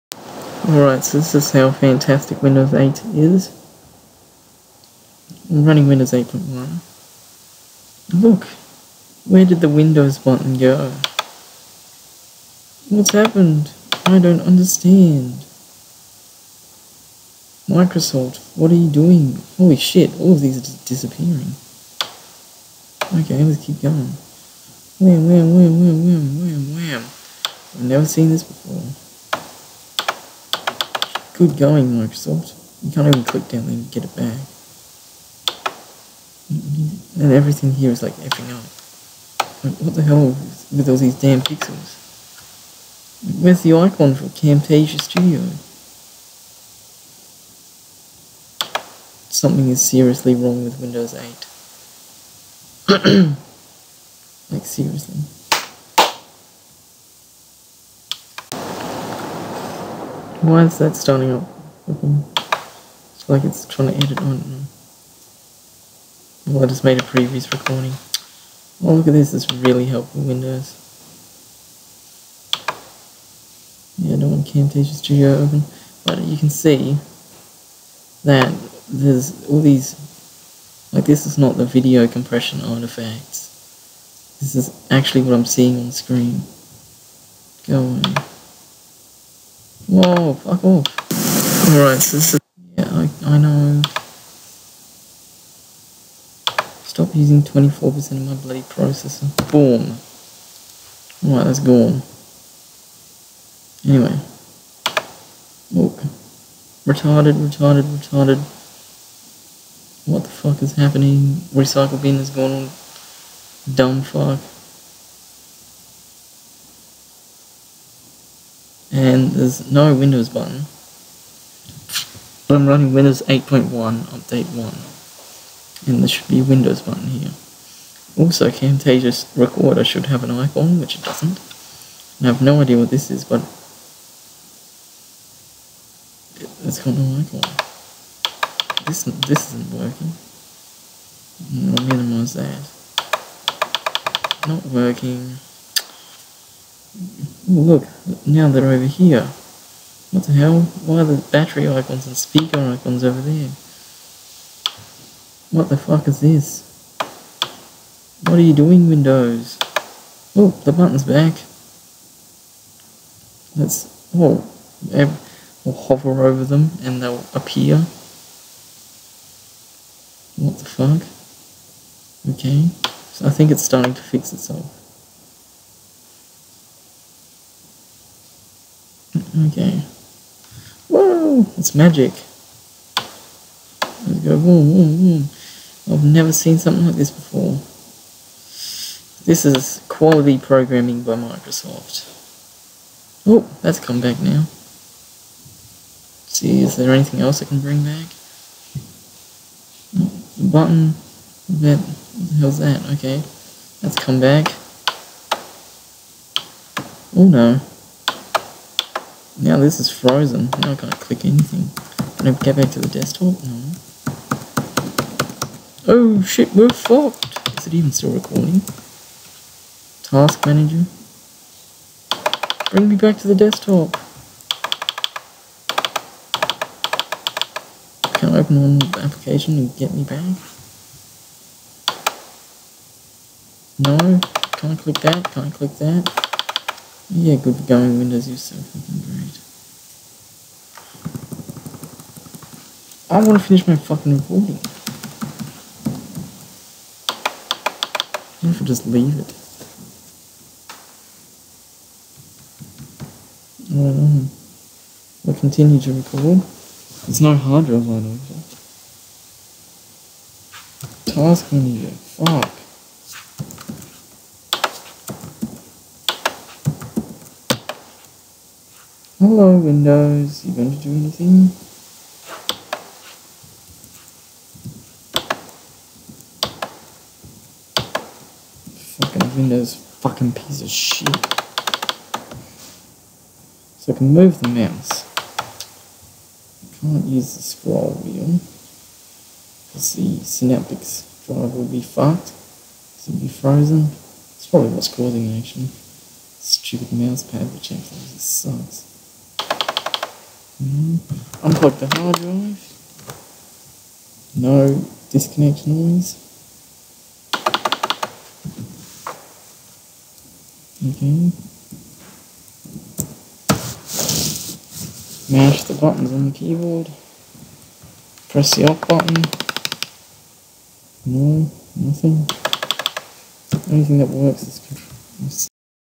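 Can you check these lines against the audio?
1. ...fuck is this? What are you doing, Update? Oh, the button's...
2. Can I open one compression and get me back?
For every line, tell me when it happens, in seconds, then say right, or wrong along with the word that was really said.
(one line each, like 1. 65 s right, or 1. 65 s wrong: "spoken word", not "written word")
1. 155 s wrong: "Windows", not "Update"
2. 228 s wrong: "application", not "compression".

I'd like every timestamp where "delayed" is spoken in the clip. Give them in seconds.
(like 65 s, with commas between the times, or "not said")
not said.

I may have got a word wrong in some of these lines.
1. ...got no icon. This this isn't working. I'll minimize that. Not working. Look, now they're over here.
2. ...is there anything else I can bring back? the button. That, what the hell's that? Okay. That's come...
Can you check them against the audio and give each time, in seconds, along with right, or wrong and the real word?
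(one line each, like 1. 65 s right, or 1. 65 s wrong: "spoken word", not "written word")
1. 136 s right
2. 196 s right.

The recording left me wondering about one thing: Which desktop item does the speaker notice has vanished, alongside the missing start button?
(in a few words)
Recycle bin.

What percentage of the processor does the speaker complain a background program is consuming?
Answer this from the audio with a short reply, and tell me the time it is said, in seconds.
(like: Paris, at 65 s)
24%, at 97 s.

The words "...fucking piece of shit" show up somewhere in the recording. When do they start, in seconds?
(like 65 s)
279 s.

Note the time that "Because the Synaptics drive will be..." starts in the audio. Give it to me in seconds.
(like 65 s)
289 s.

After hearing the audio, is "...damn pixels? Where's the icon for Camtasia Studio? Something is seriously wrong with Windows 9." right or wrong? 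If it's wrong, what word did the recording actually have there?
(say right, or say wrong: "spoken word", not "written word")
wrong: "8", not "9".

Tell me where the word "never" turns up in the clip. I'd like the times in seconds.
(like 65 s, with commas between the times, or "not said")
27 s, 186 s.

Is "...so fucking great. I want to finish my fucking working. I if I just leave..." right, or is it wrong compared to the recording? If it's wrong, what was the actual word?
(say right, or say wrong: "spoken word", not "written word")
wrong: "recording", not "working".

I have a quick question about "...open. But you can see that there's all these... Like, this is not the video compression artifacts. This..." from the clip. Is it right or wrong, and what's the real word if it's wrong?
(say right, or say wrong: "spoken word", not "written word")
right.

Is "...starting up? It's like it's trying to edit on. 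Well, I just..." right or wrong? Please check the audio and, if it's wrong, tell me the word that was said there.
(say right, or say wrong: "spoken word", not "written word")
right.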